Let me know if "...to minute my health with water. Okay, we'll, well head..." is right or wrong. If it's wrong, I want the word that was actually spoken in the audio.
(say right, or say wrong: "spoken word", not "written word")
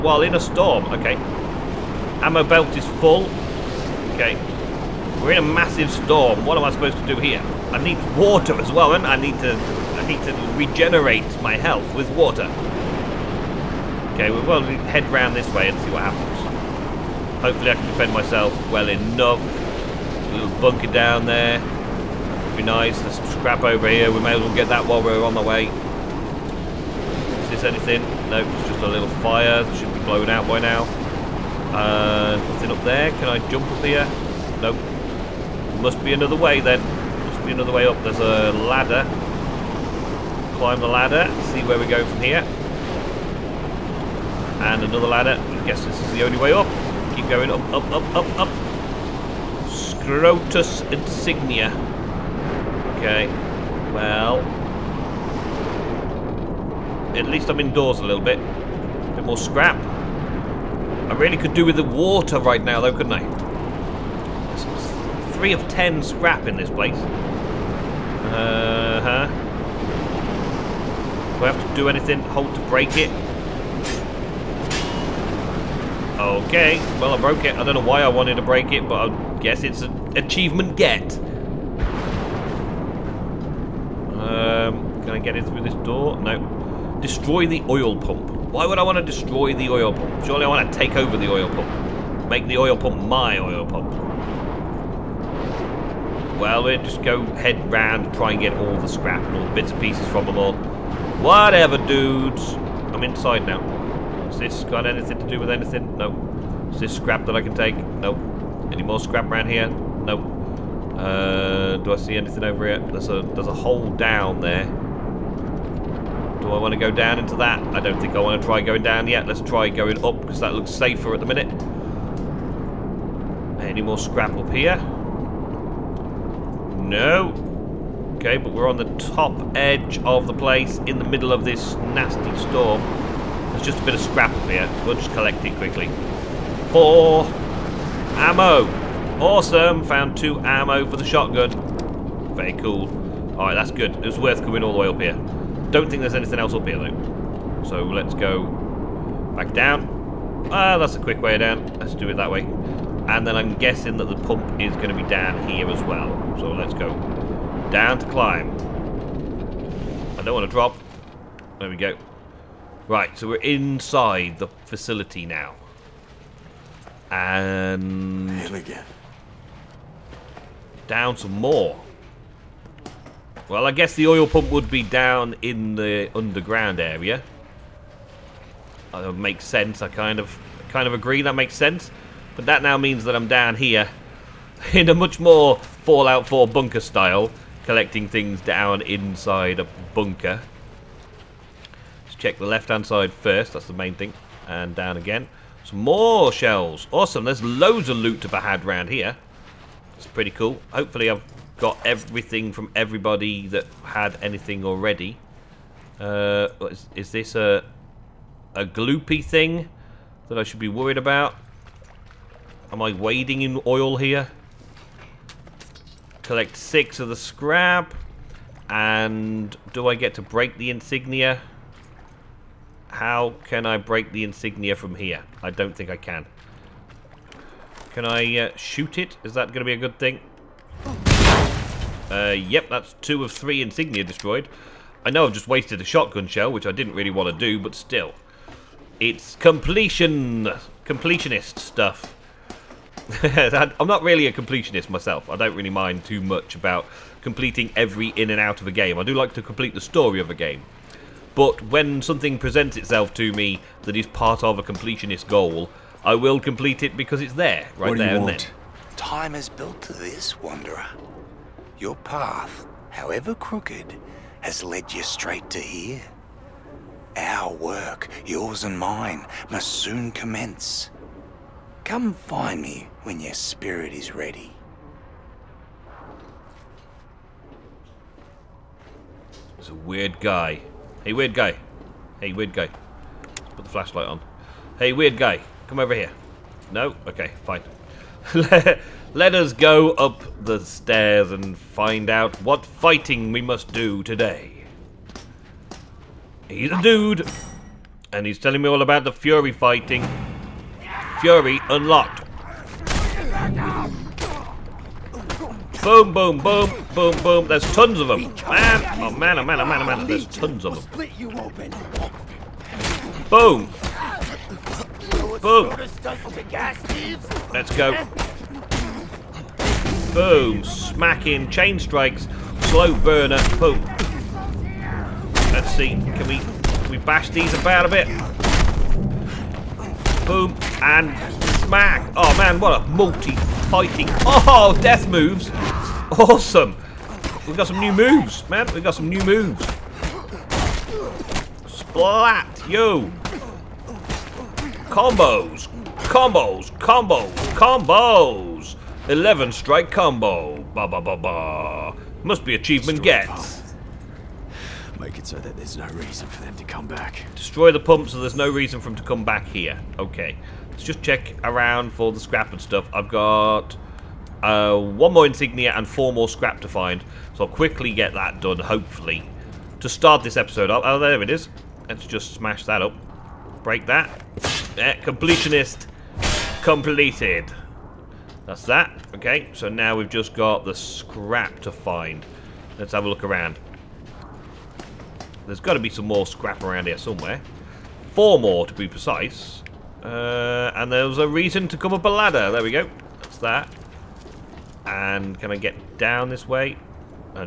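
wrong: "regenerate", not "minute".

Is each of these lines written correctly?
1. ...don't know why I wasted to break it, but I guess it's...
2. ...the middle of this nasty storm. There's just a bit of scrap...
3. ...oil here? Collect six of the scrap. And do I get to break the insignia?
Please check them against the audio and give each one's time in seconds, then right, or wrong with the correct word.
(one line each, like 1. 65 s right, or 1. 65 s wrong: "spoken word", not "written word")
1. 77 s wrong: "wanted", not "wasted"
2. 130 s right
3. 213 s right.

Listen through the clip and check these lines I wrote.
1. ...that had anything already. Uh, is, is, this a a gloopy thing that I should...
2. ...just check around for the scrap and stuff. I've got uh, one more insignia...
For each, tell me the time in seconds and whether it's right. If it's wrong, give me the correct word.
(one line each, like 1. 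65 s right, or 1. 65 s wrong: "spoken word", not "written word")
1. 203 s right
2. 360 s right.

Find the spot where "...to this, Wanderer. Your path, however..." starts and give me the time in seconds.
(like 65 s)
259 s.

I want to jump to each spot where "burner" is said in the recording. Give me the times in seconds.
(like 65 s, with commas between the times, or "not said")
322 s.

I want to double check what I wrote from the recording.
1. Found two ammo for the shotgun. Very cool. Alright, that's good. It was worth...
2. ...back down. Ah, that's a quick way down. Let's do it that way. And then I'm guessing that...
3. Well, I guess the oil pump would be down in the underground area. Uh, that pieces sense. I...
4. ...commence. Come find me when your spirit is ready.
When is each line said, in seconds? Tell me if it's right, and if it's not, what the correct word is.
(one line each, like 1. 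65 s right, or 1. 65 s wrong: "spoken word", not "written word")
1. 139 s right
2. 149 s right
3. 173 s wrong: "makes", not "pieces"
4. 270 s right.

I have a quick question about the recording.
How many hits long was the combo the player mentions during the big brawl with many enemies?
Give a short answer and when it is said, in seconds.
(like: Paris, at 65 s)
11, at 349 s.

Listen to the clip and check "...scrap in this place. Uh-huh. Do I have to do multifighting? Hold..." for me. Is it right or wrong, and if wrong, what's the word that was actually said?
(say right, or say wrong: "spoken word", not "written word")
wrong: "anything", not "multifighting".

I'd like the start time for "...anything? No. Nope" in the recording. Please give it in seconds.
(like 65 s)
105 s.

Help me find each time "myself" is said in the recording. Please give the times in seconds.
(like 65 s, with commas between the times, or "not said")
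18 s, 244 s.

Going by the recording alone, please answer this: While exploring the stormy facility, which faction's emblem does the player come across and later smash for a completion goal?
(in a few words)
Scrotus.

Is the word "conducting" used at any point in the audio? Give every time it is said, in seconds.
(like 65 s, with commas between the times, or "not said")
not said.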